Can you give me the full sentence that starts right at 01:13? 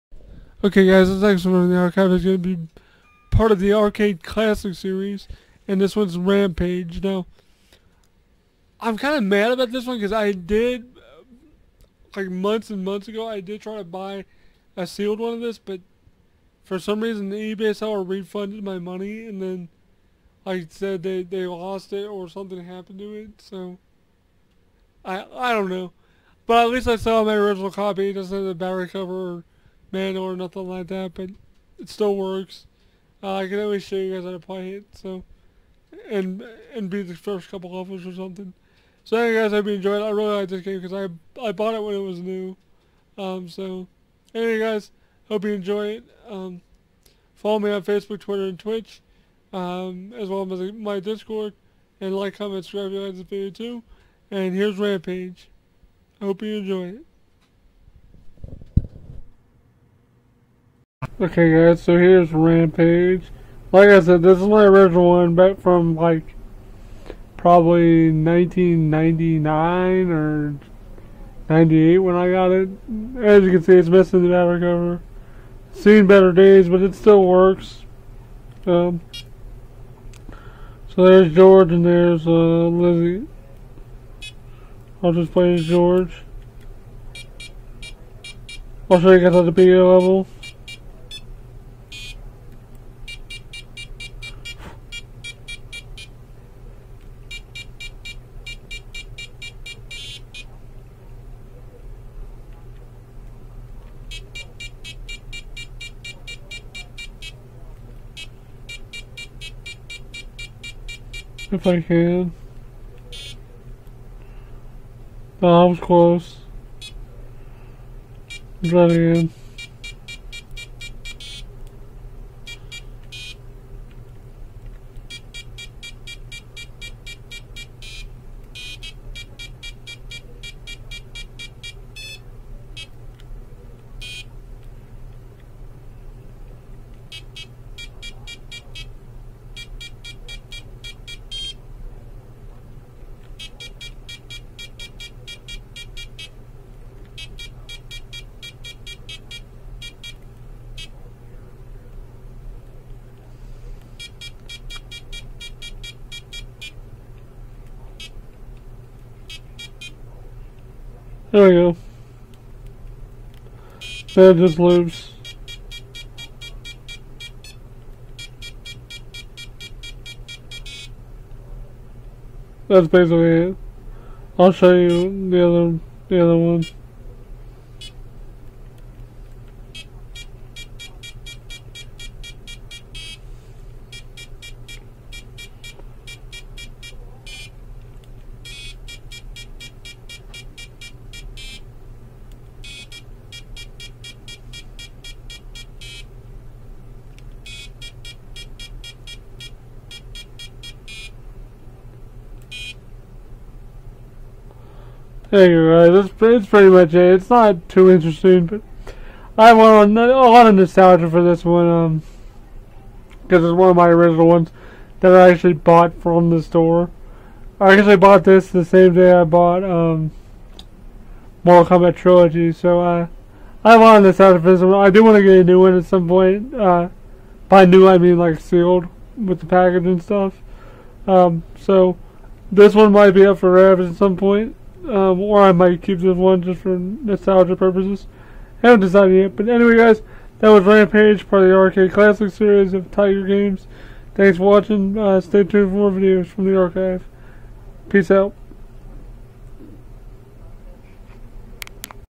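As you can see, it's missing the battery cover.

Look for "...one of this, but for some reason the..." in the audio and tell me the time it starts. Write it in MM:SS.
00:15.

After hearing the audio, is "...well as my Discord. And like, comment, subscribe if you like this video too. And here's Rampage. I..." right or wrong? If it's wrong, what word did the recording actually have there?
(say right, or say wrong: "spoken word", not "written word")
right.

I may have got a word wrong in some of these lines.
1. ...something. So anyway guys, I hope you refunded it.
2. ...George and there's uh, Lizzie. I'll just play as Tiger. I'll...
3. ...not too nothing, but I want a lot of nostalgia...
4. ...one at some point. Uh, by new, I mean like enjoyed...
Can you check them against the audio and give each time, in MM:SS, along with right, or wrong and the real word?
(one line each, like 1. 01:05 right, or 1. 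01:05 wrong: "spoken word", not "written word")
1. 00:38 wrong: "enjoyed", not "refunded"
2. 01:21 wrong: "George", not "Tiger"
3. 03:27 wrong: "interesting", not "nothing"
4. 03:45 wrong: "sealed", not "enjoyed".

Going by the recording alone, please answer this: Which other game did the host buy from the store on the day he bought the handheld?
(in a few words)
Mortal Kombat Trilogy.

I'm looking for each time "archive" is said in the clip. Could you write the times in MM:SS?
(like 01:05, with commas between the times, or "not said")
00:01, 04:06.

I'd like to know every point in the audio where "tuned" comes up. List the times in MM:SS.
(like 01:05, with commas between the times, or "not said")
04:05.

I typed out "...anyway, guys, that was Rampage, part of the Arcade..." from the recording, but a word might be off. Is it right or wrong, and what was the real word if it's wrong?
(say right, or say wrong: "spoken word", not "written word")
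right.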